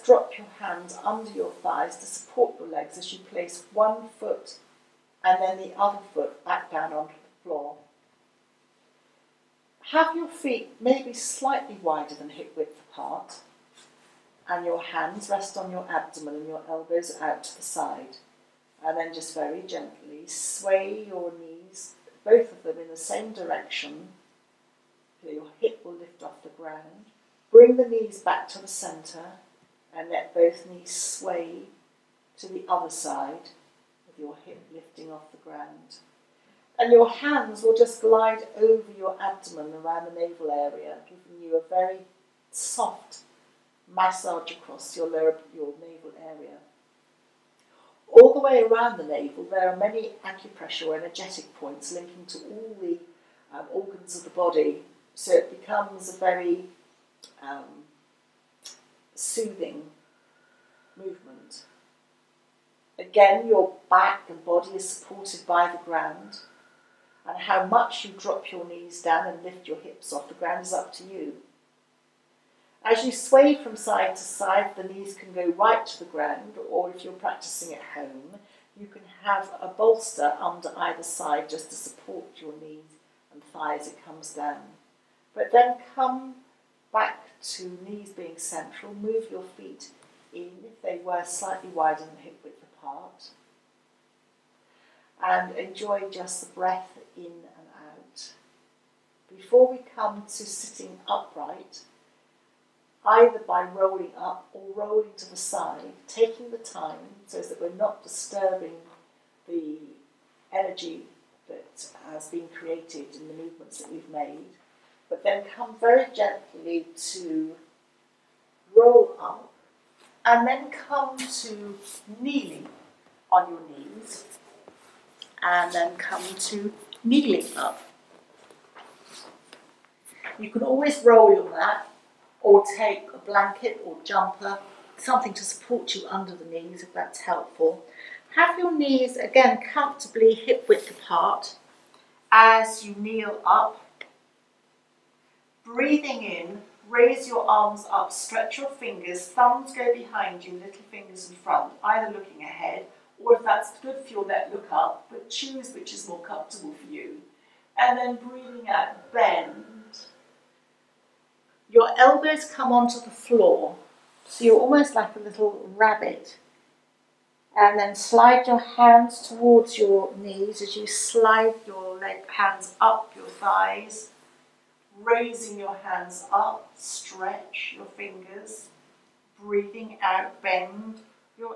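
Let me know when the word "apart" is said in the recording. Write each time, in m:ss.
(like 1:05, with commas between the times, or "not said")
0:12, 1:32, 2:20.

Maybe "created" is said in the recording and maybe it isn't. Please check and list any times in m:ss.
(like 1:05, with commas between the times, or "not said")
1:52.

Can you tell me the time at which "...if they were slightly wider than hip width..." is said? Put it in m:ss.
1:30.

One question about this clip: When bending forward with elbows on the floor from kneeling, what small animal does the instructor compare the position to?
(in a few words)
rabbit.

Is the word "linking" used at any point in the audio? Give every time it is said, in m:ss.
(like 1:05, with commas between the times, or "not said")
0:51.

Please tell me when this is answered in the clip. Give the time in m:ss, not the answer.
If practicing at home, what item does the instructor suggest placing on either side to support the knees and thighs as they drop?
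1:19.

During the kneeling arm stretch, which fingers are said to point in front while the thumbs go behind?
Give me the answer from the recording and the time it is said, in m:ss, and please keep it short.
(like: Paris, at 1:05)
little fingers, at 2:30.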